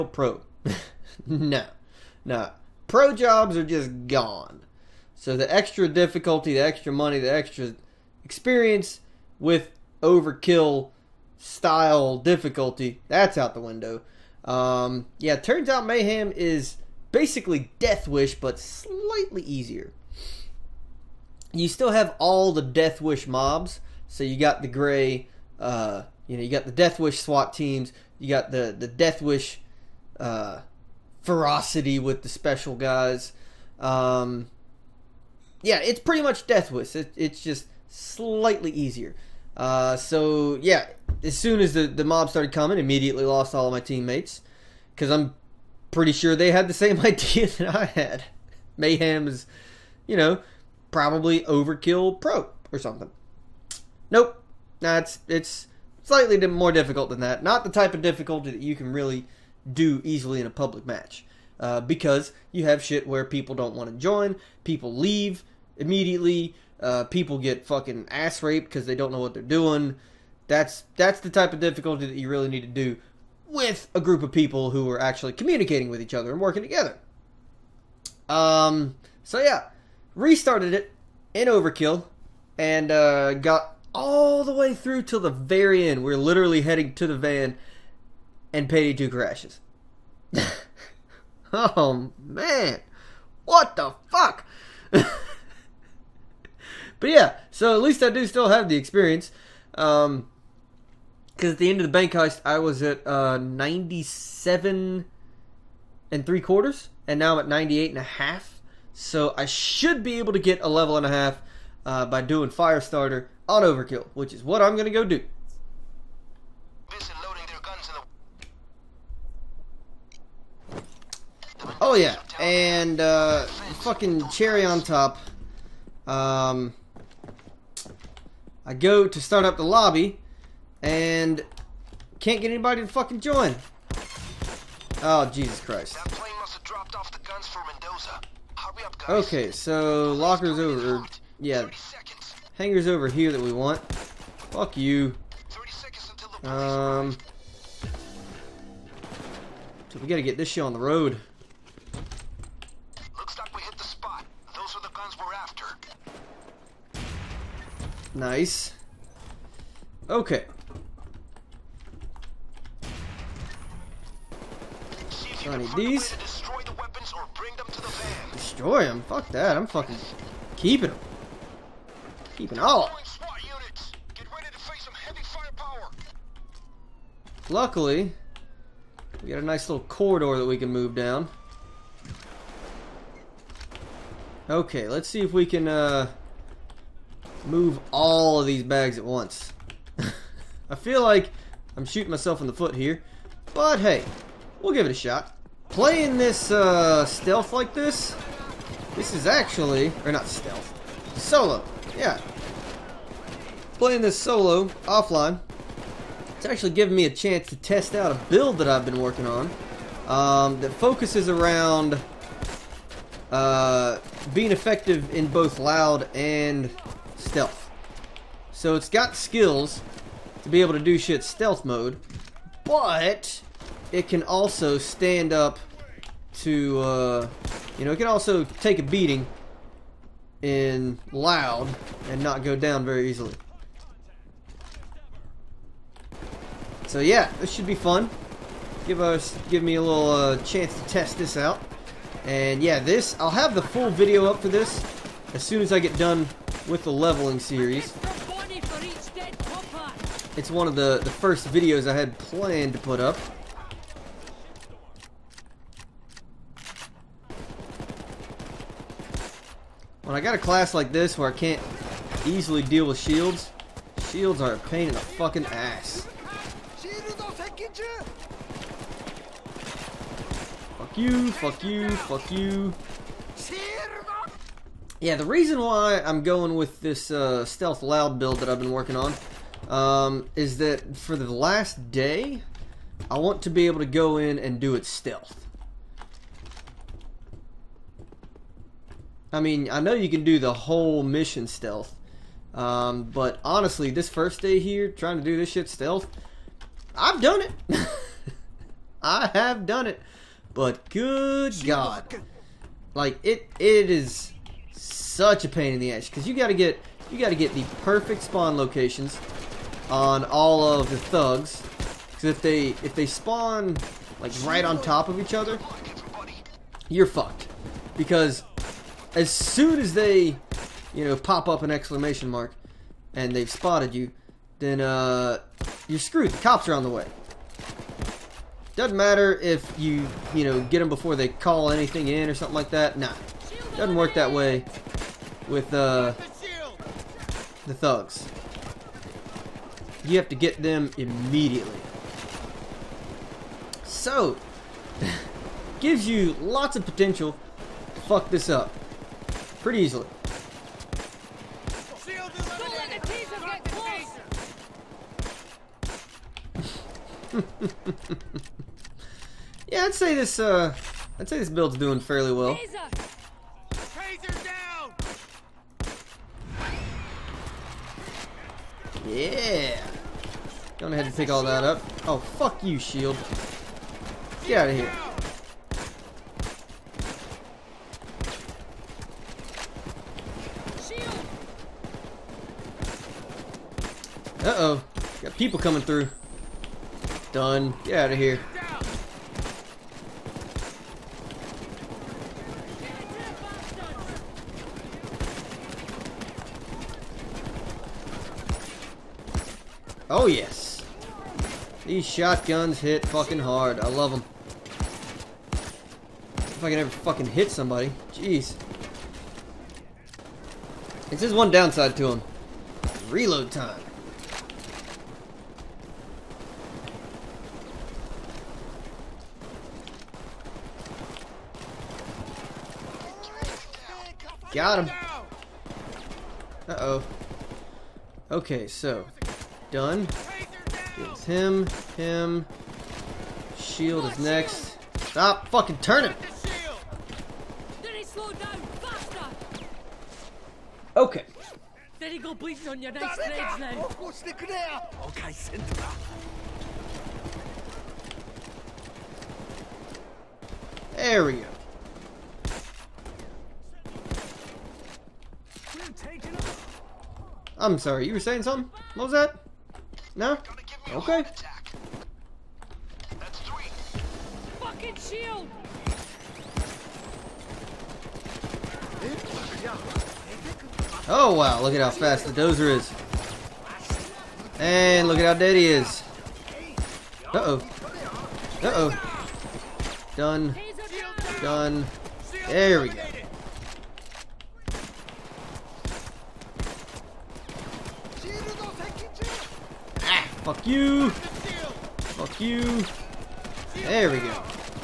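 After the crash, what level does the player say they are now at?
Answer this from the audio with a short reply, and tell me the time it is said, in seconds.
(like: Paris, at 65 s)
98 and a half, at 107 s.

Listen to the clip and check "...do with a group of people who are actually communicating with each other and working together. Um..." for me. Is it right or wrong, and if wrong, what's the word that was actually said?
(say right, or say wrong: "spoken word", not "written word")
right.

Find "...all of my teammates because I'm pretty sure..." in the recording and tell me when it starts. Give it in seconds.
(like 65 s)
43 s.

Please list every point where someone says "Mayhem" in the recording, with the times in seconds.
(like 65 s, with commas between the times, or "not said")
15 s, 48 s.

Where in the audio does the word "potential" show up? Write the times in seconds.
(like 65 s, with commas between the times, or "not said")
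346 s.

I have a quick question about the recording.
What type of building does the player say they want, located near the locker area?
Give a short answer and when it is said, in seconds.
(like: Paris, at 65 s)
Hangar, at 142 s.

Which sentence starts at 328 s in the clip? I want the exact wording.
Doesn't matter if you, you know, get them before they call anything in or something like that.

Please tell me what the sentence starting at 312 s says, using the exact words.
Because if they if they spawn like right on top of each other, you're fucked.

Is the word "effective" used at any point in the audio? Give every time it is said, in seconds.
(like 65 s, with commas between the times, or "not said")
214 s.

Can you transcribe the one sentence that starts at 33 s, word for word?
Um, yeah, it's pretty much Death Wish.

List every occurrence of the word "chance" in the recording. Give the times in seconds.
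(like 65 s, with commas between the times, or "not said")
207 s, 240 s.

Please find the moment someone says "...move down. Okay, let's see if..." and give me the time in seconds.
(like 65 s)
180 s.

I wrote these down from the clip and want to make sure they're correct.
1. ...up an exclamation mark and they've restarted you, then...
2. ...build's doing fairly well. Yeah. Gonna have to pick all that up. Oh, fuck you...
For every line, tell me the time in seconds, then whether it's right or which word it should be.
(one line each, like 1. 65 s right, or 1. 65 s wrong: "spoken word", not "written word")
1. 321 s wrong: "spotted", not "restarted"
2. 361 s right.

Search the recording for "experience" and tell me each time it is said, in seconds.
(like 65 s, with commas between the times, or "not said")
8 s, 98 s.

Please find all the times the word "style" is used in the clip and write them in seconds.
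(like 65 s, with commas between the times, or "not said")
11 s.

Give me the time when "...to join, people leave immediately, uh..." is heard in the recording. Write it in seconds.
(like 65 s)
63 s.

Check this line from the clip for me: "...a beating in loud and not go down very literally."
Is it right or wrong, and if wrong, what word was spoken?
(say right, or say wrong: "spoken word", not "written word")
wrong: "easily", not "literally".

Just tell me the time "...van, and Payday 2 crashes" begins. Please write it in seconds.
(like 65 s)
87 s.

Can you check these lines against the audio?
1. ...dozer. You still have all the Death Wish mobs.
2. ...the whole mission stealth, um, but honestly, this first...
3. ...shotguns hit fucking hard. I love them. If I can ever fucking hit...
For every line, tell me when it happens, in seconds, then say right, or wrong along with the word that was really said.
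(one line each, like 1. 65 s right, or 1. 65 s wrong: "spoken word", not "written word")
1. 19 s wrong: "easier", not "dozer"
2. 290 s right
3. 402 s right.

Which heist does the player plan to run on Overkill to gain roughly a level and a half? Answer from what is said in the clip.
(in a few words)
Firestarter.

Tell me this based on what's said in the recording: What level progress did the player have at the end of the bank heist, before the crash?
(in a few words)
97 and three quarters.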